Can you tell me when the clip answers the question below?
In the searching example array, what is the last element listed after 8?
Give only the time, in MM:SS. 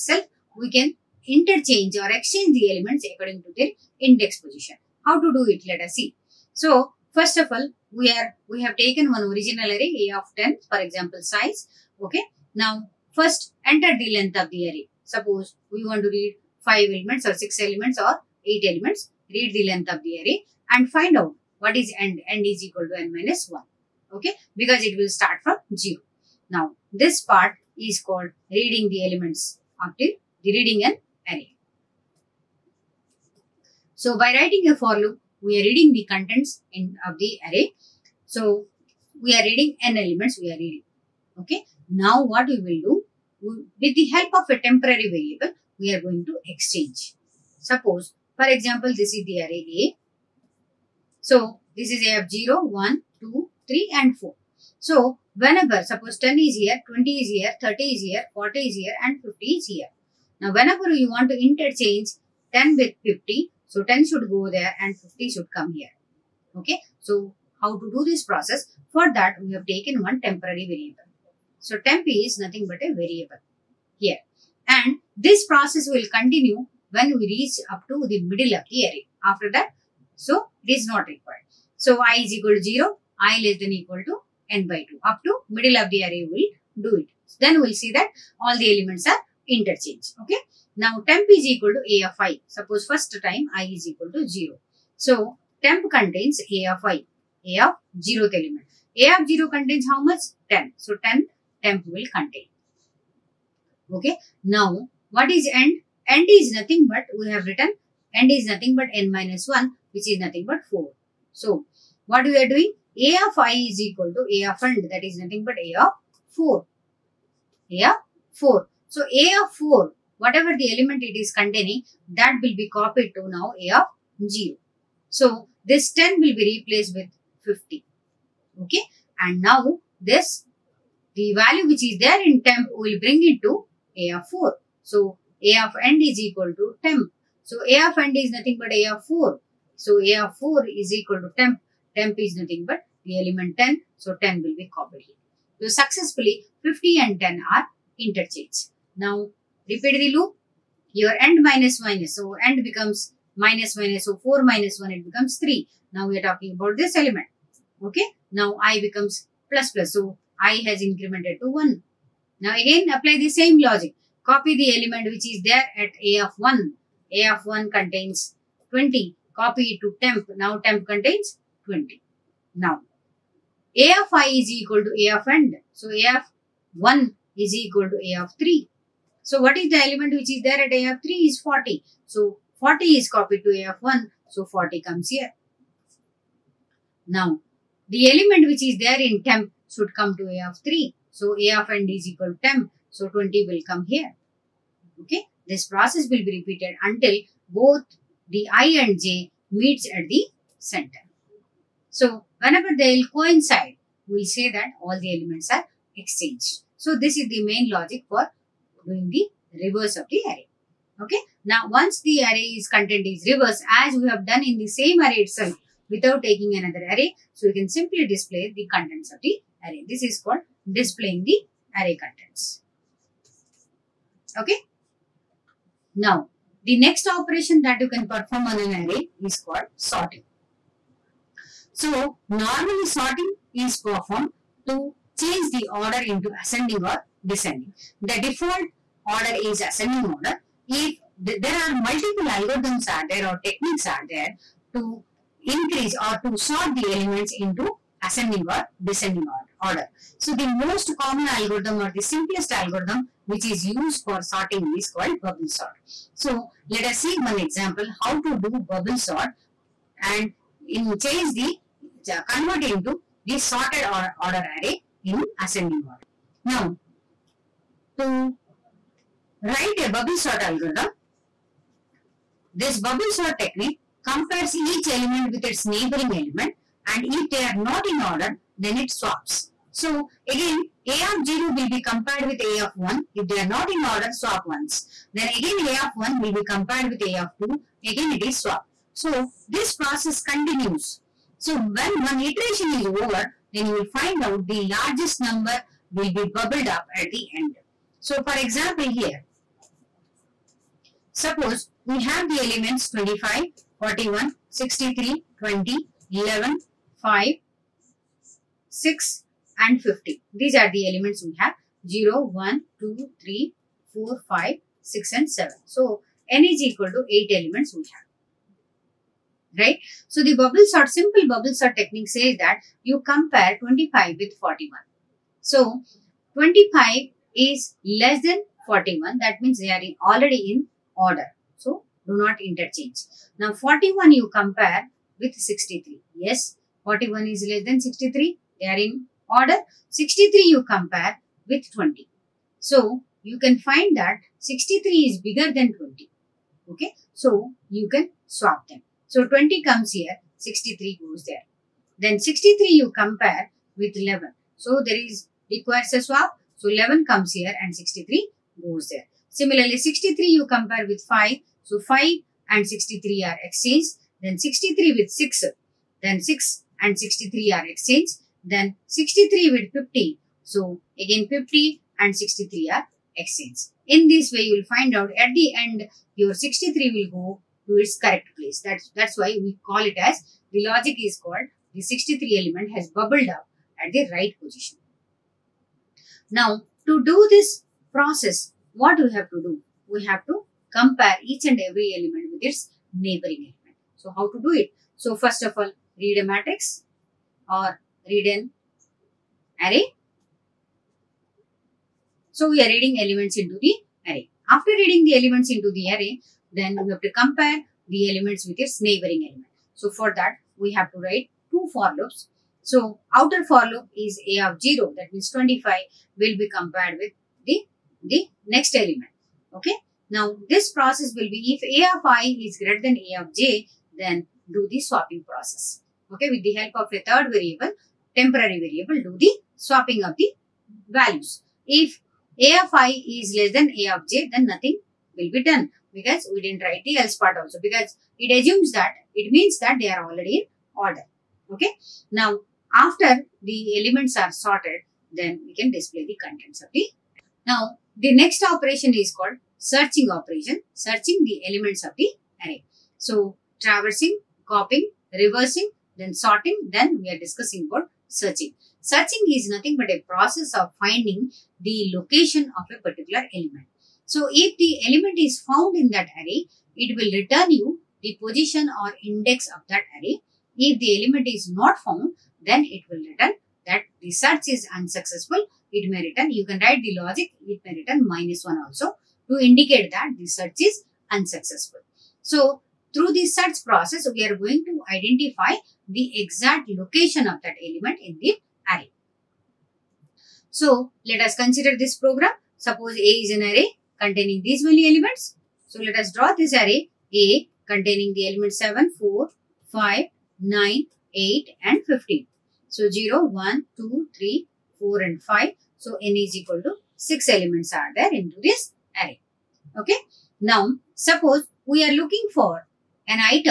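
08:21.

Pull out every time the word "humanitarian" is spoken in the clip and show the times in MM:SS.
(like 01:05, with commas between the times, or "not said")
not said.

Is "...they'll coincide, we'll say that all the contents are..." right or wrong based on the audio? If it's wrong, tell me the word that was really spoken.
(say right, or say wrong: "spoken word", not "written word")
wrong: "elements", not "contents".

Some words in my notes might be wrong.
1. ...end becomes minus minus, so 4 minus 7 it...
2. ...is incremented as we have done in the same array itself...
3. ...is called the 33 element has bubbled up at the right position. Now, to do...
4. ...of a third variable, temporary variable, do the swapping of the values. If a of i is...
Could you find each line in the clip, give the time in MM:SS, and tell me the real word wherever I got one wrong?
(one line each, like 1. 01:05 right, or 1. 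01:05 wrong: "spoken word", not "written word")
1. 02:32 wrong: "1", not "7"
2. 03:33 wrong: "reversed", not "incremented"
3. 06:20 wrong: "63", not "33"
4. 07:06 right.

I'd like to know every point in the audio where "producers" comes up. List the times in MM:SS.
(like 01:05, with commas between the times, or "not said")
not said.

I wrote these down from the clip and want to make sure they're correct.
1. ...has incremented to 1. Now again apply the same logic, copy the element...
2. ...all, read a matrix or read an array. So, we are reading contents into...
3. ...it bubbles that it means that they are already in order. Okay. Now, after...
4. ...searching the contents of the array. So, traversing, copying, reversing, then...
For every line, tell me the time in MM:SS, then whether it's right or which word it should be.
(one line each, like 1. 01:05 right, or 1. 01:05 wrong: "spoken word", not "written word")
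1. 02:40 right
2. 06:35 wrong: "elements", not "contents"
3. 07:18 wrong: "assumes", not "bubbles"
4. 07:30 wrong: "elements", not "contents".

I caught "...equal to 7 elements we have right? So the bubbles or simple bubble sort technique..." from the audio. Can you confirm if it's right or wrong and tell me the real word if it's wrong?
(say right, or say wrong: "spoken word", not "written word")
wrong: "8", not "7".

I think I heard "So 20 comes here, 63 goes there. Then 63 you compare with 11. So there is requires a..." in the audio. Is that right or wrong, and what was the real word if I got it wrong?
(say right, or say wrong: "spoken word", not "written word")
right.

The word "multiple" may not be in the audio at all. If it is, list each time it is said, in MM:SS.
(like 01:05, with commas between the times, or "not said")
04:01.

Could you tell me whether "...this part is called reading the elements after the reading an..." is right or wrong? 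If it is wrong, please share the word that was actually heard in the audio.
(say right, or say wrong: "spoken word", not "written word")
right.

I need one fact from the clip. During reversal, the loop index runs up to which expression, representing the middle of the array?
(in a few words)
n by 2.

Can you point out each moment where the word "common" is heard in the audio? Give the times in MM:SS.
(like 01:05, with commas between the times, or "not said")
04:11.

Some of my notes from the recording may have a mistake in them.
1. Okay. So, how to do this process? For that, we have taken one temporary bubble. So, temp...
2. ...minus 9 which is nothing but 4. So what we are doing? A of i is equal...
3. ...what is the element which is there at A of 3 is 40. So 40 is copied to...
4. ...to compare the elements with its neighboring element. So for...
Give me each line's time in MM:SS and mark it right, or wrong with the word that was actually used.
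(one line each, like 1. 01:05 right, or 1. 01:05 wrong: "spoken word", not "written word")
1. 01:06 wrong: "variable", not "bubble"
2. 01:49 wrong: "1", not "9"
3. 02:59 right
4. 06:47 right.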